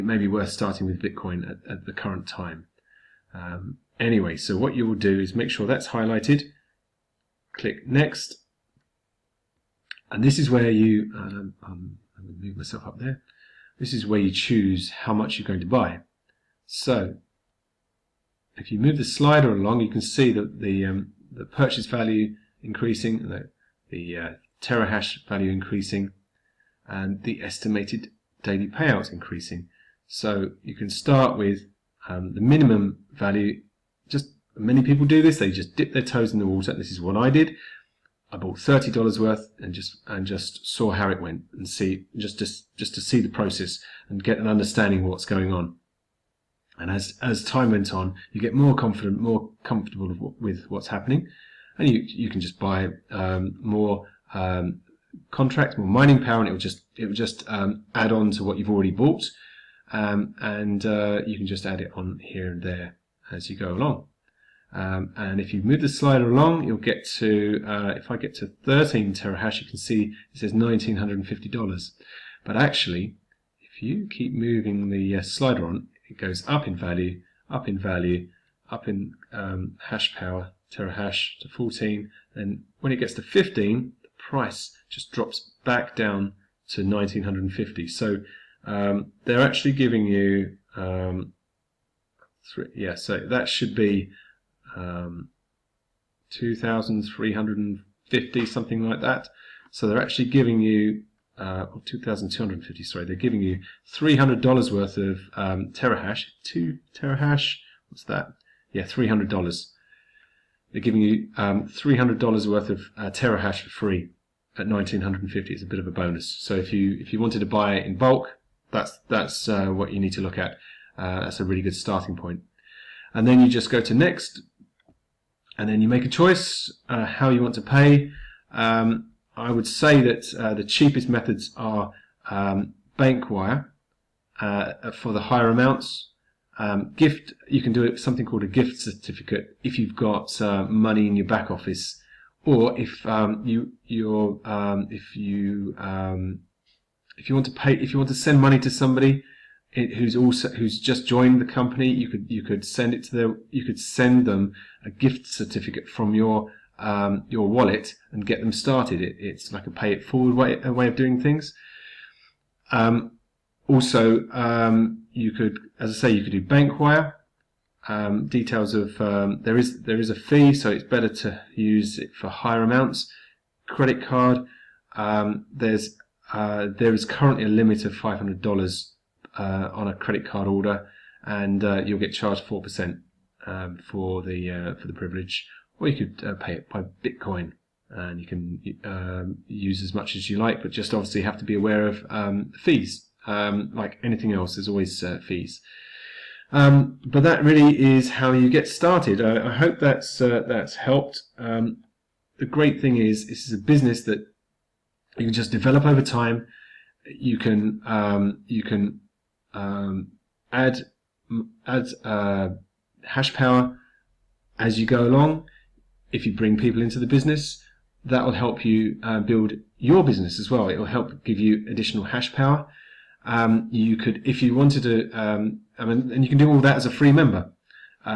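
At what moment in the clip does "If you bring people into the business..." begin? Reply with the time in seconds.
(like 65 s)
216 s.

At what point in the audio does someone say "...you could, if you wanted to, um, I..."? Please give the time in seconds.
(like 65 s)
223 s.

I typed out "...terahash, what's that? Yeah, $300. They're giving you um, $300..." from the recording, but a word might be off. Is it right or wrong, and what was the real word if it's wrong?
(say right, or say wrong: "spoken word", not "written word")
right.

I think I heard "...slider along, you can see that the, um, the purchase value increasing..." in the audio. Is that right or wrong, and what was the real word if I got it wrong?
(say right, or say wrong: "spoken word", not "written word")
right.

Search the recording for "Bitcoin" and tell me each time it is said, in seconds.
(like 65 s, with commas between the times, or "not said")
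1 s, 187 s.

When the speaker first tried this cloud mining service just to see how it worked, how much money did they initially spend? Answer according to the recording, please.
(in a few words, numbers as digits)
$30.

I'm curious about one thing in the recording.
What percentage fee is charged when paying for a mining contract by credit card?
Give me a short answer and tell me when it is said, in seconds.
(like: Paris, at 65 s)
4%, at 182 s.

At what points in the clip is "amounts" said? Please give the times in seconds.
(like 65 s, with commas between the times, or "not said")
135 s, 172 s.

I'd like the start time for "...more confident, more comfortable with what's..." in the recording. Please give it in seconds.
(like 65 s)
48 s.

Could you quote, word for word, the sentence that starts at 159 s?
It, it's like a pay it forward way a way of doing things.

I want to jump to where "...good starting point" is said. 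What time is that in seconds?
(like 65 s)
121 s.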